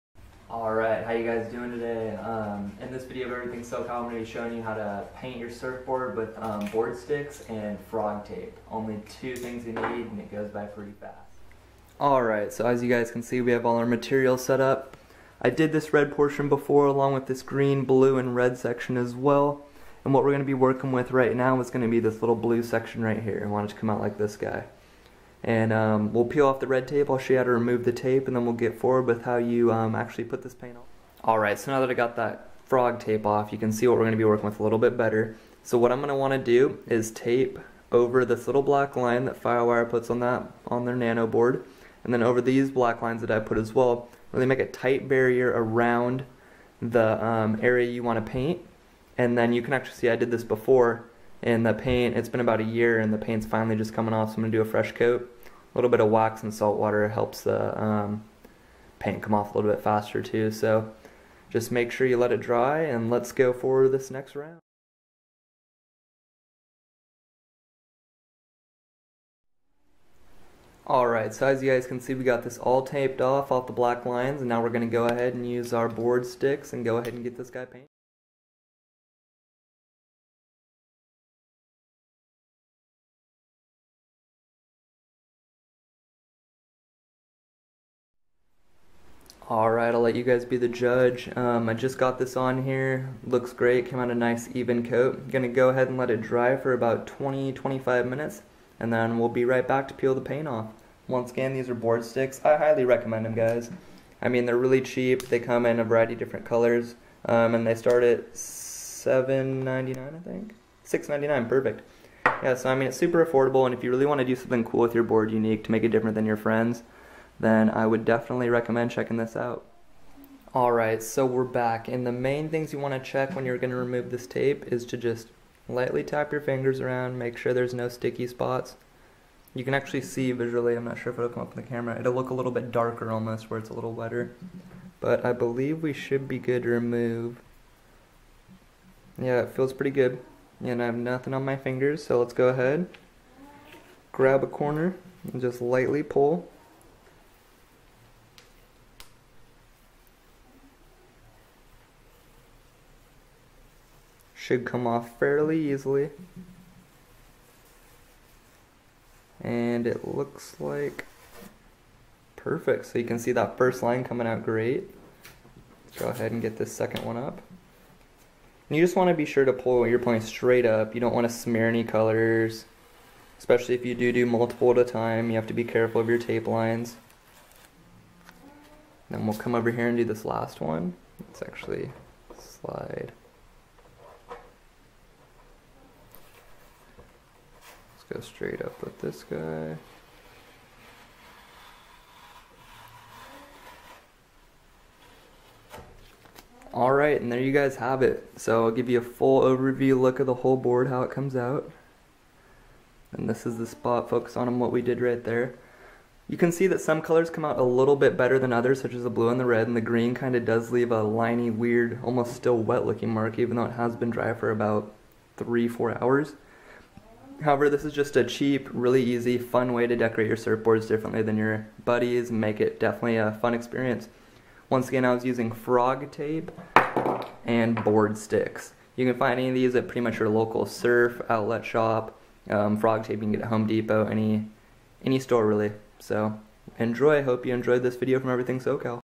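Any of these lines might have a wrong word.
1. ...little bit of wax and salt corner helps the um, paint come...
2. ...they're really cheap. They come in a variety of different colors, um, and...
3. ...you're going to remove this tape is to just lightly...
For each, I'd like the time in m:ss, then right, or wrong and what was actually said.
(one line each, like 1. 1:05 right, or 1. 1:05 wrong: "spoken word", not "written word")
1. 0:55 wrong: "water", not "corner"
2. 1:44 right
3. 2:03 right.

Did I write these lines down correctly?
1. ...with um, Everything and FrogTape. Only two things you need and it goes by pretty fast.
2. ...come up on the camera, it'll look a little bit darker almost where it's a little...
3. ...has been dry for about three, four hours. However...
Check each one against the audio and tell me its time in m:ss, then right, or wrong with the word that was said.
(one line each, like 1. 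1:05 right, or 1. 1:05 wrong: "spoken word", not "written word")
1. 0:06 wrong: "BoardStix", not "Everything"
2. 2:11 right
3. 3:33 right.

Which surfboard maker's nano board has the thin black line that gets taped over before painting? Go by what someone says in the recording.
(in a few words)
Firewire.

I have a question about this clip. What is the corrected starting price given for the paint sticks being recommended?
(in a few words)
$6.99.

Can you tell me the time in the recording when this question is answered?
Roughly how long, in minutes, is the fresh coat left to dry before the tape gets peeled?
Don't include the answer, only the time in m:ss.
1:37.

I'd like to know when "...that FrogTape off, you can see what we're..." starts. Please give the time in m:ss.
0:32.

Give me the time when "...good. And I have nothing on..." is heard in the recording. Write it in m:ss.
2:19.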